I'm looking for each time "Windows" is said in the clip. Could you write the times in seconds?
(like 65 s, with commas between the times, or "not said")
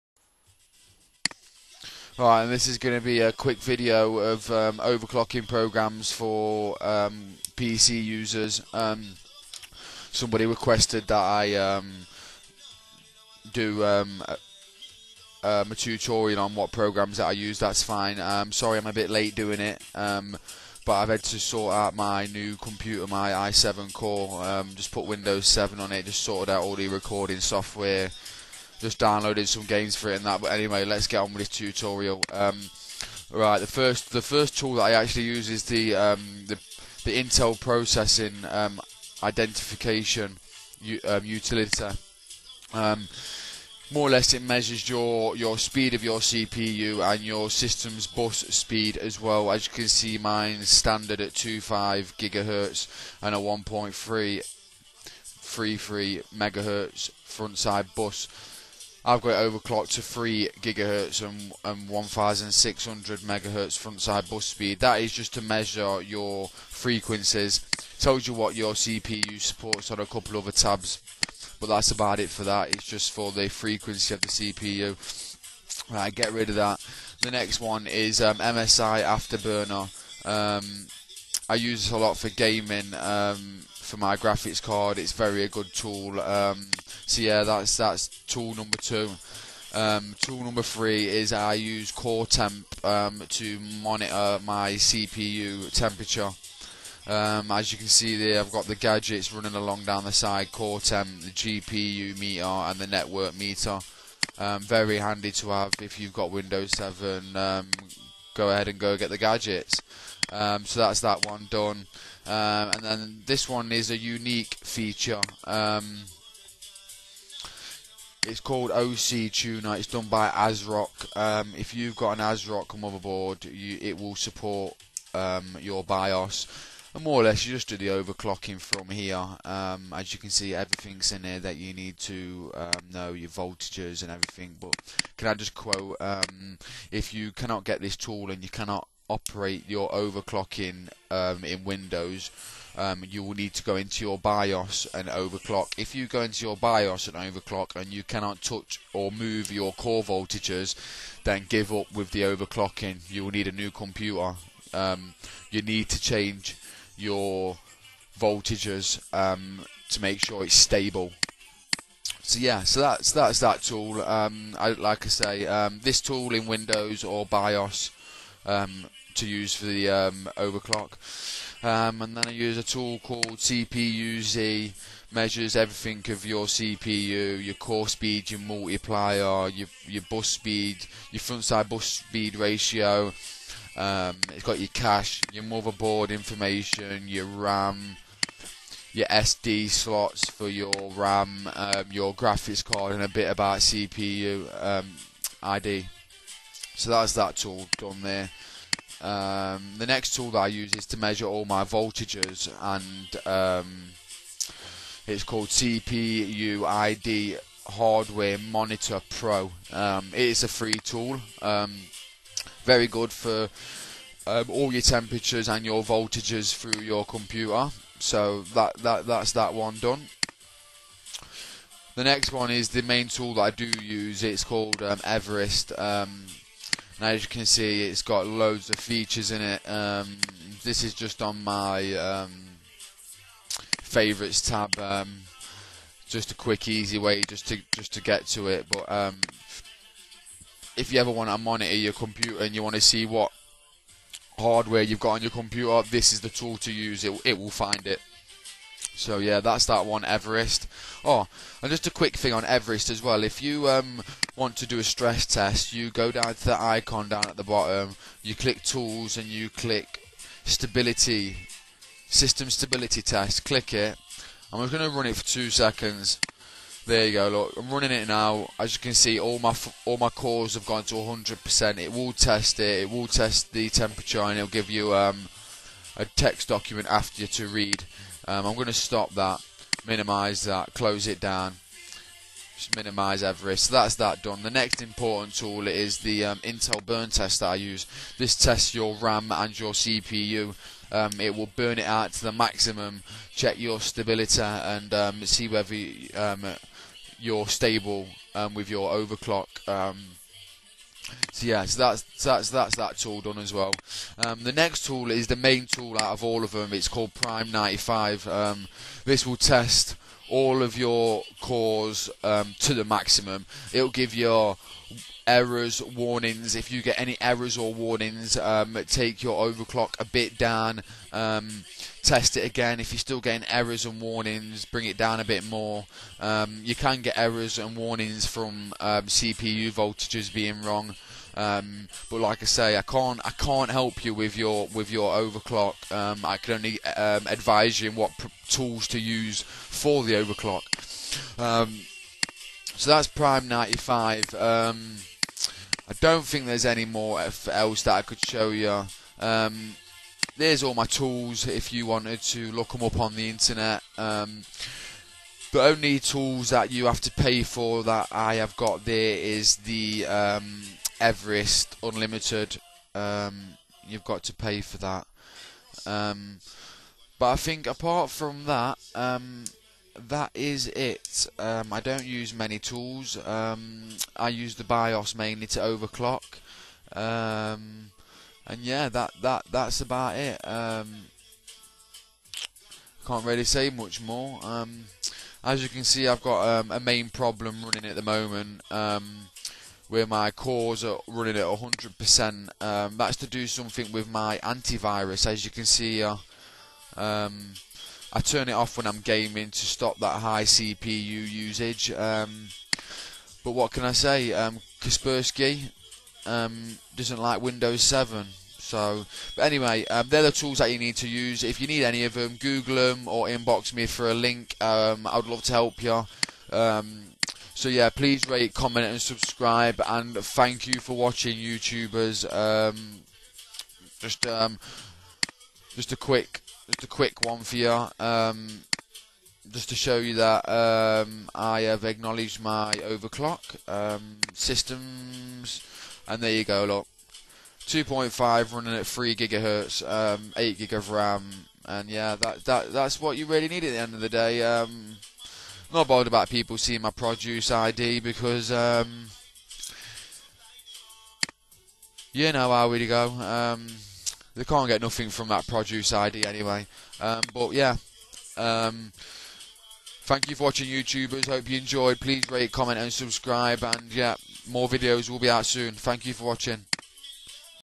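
25 s, 106 s, 141 s, 166 s, 407 s.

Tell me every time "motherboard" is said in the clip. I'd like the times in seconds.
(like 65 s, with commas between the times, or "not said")
122 s, 185 s.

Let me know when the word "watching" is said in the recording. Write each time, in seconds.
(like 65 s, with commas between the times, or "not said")
420 s, 460 s, 466 s.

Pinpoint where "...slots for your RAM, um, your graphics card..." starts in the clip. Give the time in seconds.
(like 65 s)
189 s.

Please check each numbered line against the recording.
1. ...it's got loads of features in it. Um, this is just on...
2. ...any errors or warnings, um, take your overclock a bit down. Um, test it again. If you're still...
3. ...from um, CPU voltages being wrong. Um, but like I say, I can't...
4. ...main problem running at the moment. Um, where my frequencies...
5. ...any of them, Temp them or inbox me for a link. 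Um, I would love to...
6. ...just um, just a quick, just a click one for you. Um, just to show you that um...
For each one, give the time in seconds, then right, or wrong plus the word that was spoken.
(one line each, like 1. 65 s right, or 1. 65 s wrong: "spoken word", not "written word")
1. 227 s right
2. 316 s right
3. 328 s right
4. 386 s wrong: "cores", not "frequencies"
5. 411 s wrong: "Google", not "Temp"
6. 423 s wrong: "quick", not "click".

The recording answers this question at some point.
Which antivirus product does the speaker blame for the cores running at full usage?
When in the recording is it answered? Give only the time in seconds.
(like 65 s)
404 s.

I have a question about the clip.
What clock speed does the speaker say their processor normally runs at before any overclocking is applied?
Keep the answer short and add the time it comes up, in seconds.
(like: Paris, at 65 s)
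2.5 GHz, at 51 s.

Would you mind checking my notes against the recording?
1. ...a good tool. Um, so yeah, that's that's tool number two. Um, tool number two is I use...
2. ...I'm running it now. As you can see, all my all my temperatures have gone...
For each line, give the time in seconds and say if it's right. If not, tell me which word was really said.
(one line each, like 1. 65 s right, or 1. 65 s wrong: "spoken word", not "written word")
1. 85 s wrong: "three", not "two"
2. 267 s wrong: "cores", not "temperatures".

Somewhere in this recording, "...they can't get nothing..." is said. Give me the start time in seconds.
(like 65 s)
454 s.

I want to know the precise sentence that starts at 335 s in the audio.
Um, I can only um, advise you in what pr- tools to use for the overclock.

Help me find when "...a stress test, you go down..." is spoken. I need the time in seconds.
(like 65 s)
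254 s.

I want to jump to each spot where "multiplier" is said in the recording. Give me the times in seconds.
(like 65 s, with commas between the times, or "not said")
178 s.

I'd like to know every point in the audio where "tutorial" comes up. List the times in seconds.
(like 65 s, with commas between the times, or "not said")
15 s, 31 s.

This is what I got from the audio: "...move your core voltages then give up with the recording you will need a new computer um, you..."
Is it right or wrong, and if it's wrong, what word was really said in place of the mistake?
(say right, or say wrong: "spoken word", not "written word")
wrong: "overclocking", not "recording".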